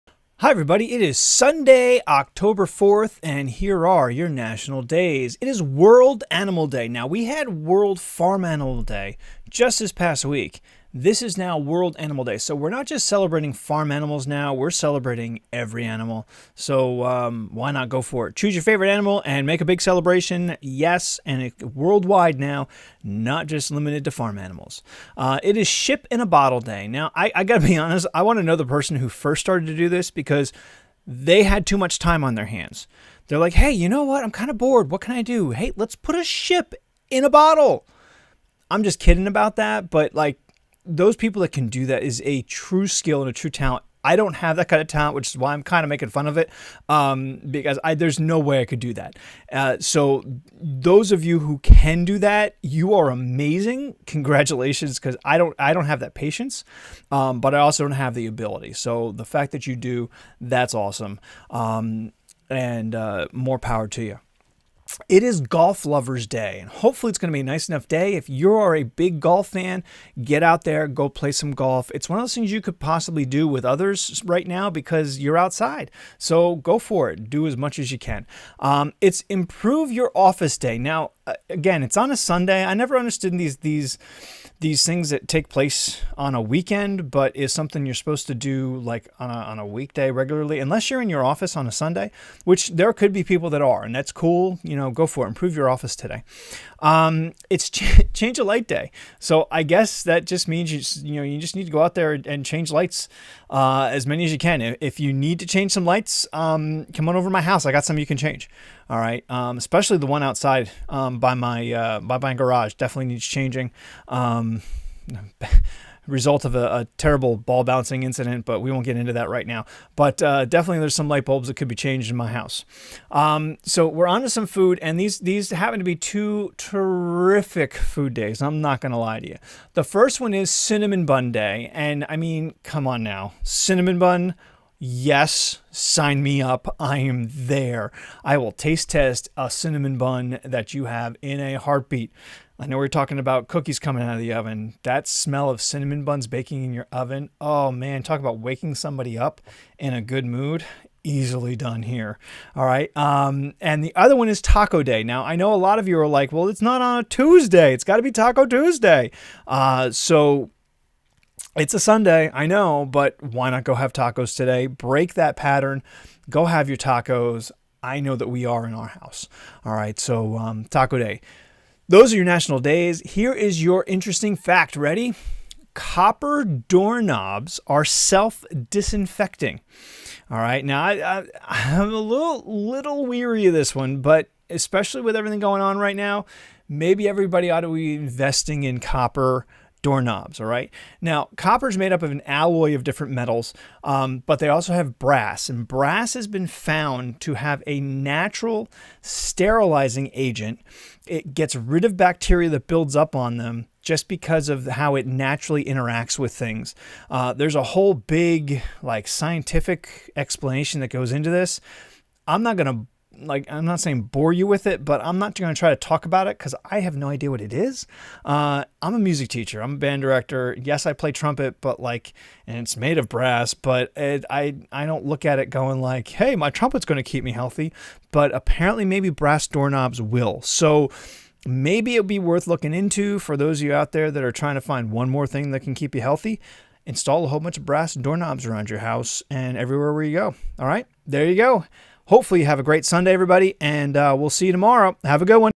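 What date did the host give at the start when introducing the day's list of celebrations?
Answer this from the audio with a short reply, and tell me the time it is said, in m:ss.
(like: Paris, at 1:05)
October 4, at 0:02.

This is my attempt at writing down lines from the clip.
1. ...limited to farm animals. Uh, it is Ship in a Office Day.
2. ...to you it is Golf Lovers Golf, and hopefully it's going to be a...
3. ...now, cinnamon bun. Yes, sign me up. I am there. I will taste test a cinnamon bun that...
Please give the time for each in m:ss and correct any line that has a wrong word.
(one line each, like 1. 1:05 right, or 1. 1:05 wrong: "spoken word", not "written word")
1. 0:23 wrong: "Bottle", not "Office"
2. 1:03 wrong: "Day", not "Golf"
3. 2:13 right.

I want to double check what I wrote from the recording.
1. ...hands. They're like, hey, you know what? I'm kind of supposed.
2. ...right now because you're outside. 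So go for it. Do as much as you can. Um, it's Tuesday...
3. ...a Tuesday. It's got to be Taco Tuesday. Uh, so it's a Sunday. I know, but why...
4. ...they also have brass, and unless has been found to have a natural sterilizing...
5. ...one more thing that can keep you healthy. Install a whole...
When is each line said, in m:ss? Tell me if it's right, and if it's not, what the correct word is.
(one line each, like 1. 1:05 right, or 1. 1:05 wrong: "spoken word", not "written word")
1. 0:32 wrong: "bored", not "supposed"
2. 1:14 wrong: "Improve", not "Tuesday"
3. 2:36 right
4. 3:14 wrong: "brass", not "unless"
5. 3:54 right.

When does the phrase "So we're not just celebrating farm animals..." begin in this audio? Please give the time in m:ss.
0:12.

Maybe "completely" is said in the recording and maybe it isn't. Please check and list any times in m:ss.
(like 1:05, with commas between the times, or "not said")
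not said.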